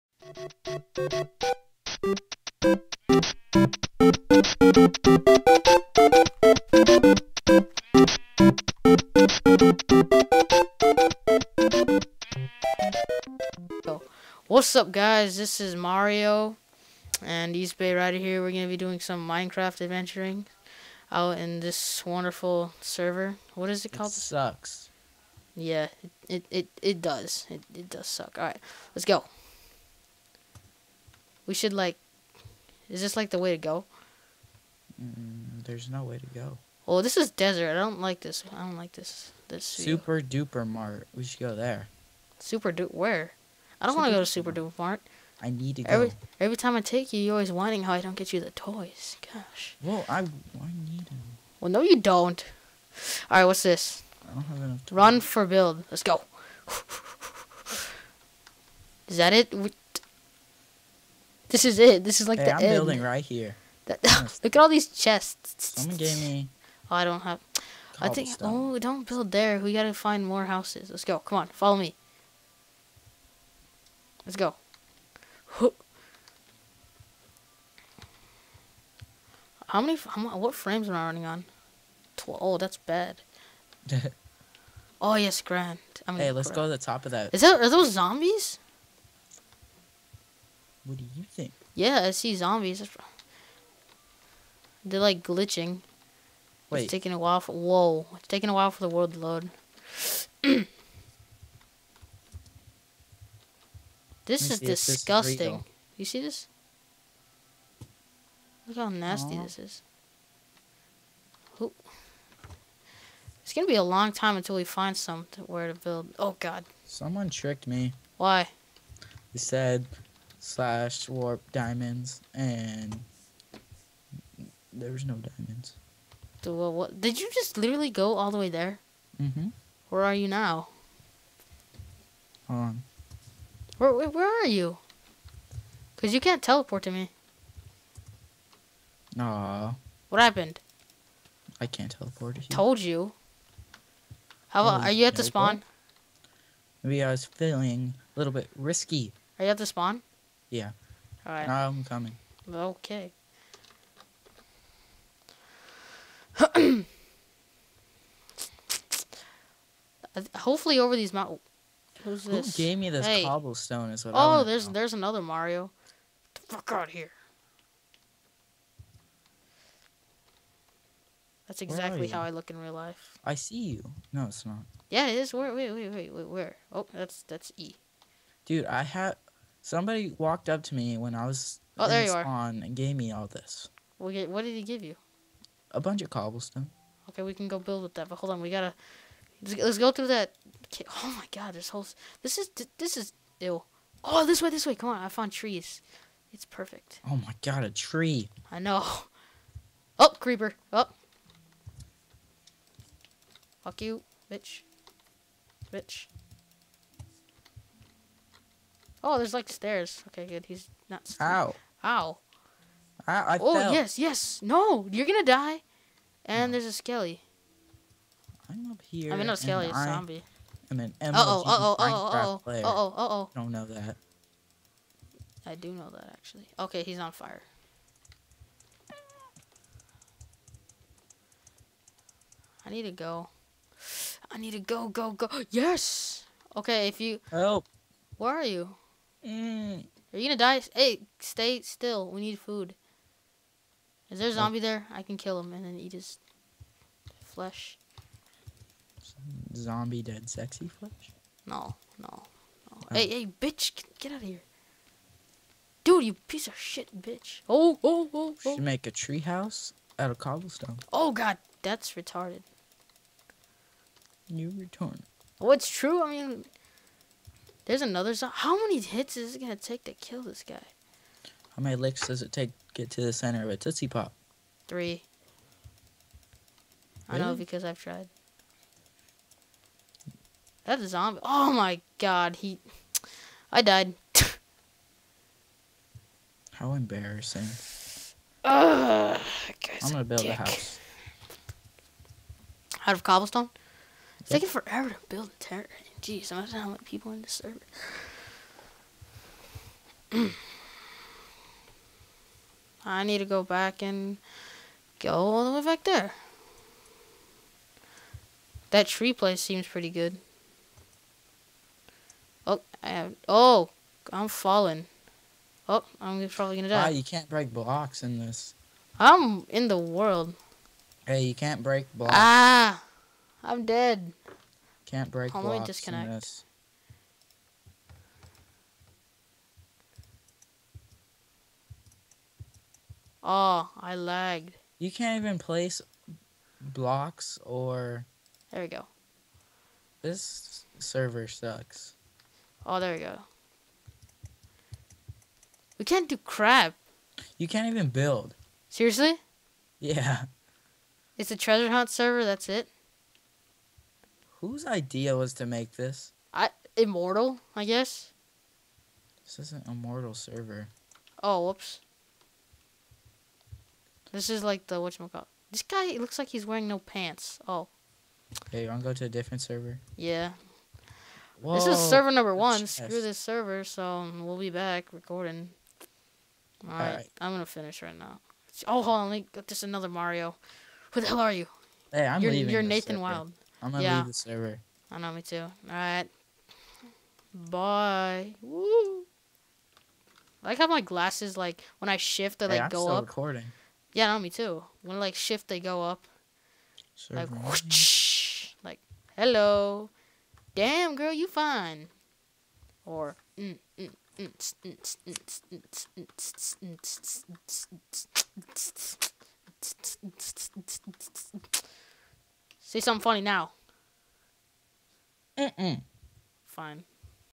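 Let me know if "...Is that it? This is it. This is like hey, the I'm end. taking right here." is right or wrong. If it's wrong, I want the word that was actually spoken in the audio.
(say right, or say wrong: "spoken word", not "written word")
wrong: "building", not "taking".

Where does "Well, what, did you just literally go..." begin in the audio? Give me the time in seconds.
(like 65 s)
126 s.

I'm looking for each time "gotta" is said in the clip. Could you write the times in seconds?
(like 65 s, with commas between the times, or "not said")
69 s, 188 s.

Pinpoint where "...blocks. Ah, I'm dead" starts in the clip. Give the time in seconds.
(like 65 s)
321 s.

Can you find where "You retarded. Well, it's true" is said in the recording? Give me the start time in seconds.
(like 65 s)
264 s.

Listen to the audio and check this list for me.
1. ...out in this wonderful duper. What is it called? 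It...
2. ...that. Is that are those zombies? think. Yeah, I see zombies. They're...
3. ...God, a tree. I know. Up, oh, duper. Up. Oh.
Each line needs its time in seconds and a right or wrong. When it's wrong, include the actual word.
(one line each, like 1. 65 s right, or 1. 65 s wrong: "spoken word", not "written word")
1. 21 s wrong: "server", not "duper"
2. 87 s right
3. 197 s wrong: "creeper", not "duper".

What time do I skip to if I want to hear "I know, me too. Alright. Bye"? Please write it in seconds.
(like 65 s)
384 s.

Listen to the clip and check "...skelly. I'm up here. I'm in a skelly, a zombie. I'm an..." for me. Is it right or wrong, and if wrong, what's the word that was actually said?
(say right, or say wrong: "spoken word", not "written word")
right.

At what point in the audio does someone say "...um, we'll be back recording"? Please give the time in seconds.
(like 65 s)
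373 s.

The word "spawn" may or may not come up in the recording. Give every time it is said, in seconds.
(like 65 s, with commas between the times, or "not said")
145 s, 149 s.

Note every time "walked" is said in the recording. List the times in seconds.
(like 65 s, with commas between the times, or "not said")
180 s.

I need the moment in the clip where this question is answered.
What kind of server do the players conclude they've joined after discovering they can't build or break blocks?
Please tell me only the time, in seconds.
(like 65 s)
351 s.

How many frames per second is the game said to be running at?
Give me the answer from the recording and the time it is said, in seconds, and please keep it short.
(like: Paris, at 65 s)
12, at 82 s.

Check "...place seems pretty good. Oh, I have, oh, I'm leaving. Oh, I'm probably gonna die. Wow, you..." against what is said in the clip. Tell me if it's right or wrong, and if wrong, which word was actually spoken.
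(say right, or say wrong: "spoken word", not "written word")
wrong: "falling", not "leaving".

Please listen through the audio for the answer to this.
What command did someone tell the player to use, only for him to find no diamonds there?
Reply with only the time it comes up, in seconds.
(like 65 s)
120 s.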